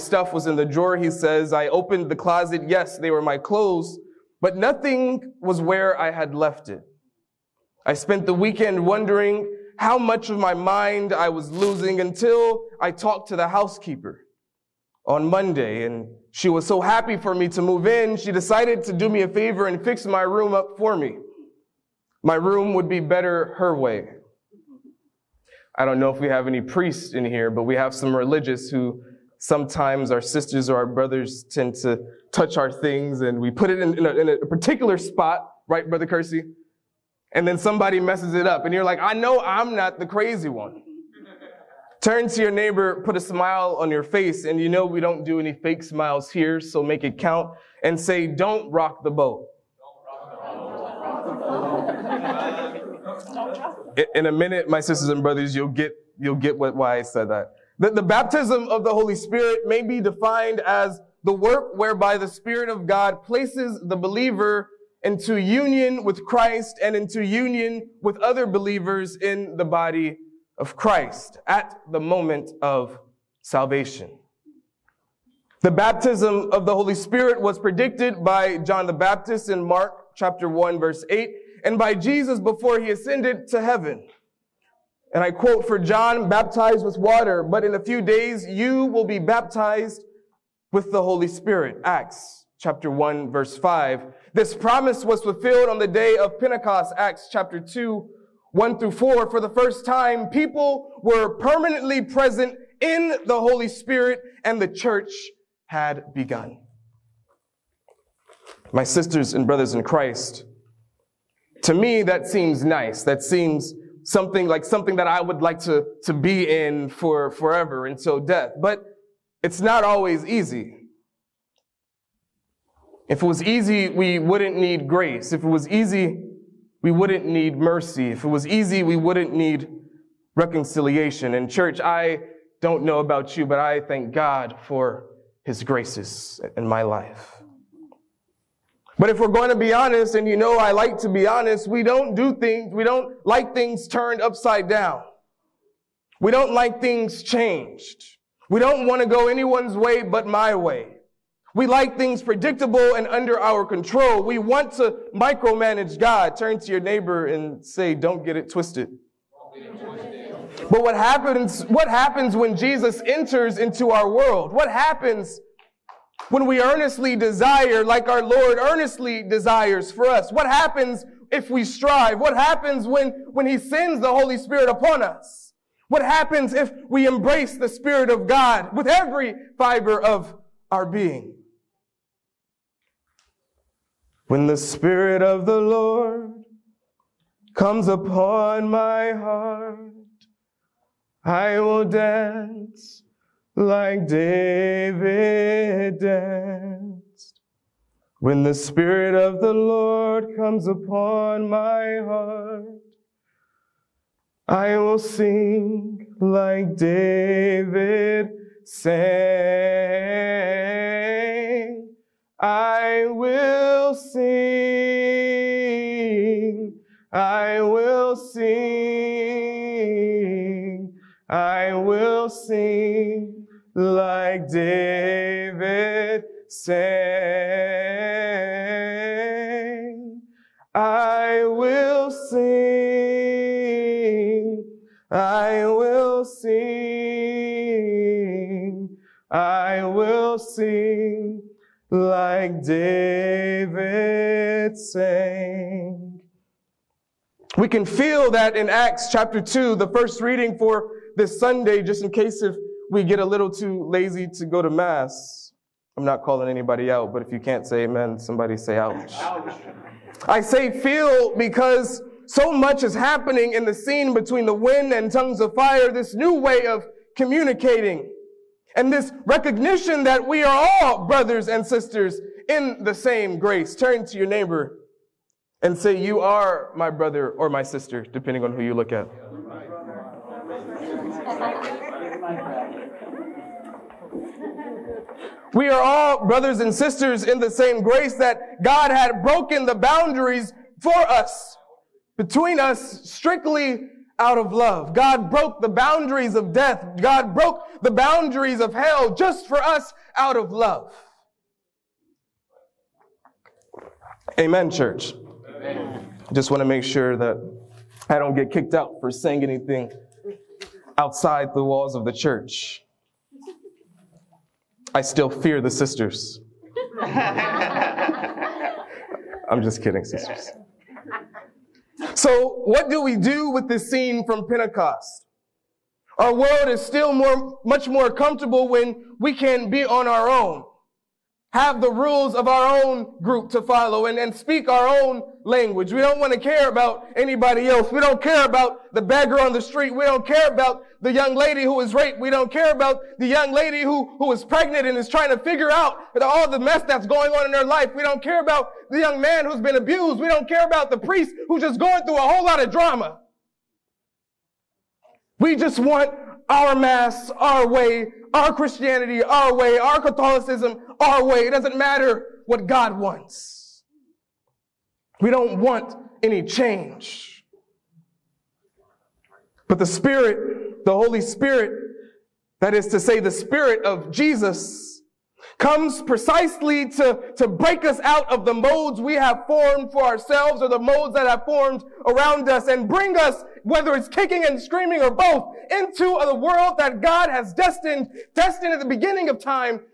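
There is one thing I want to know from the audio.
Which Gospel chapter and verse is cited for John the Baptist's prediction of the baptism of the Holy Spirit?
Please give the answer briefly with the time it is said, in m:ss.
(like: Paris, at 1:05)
Mark 1:8, at 1:19.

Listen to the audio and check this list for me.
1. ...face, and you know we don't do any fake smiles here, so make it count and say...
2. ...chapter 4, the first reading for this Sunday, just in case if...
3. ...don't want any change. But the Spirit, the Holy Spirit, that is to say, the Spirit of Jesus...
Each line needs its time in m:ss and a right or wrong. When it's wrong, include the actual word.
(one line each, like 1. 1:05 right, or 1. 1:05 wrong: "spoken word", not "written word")
1. 0:44 right
2. 4:09 wrong: "2", not "4"
3. 6:05 right.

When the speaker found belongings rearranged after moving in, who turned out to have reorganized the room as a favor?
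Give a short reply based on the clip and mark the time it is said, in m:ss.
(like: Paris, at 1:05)
the housekeeper, at 0:13.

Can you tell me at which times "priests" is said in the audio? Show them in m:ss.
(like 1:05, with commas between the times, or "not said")
0:26, 5:50.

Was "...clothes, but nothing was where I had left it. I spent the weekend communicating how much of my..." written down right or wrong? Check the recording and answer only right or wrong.
wrong.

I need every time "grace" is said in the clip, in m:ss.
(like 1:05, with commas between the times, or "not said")
2:04, 2:15, 4:33, 4:47.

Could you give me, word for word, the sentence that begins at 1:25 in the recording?
And I quote, for John baptized with water, but in a few days you will be baptized with the Holy Spirit.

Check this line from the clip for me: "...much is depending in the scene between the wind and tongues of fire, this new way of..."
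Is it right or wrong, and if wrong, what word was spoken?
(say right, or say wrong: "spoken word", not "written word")
wrong: "happening", not "depending".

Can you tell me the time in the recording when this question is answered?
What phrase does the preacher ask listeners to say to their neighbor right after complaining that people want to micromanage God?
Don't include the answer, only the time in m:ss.
2:37.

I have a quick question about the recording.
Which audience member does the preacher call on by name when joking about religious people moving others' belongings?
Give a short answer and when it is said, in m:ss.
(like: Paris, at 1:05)
Brother Kersey, at 0:35.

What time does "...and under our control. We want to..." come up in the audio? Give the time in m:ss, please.
2:32.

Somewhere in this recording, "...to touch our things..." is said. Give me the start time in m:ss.
0:31.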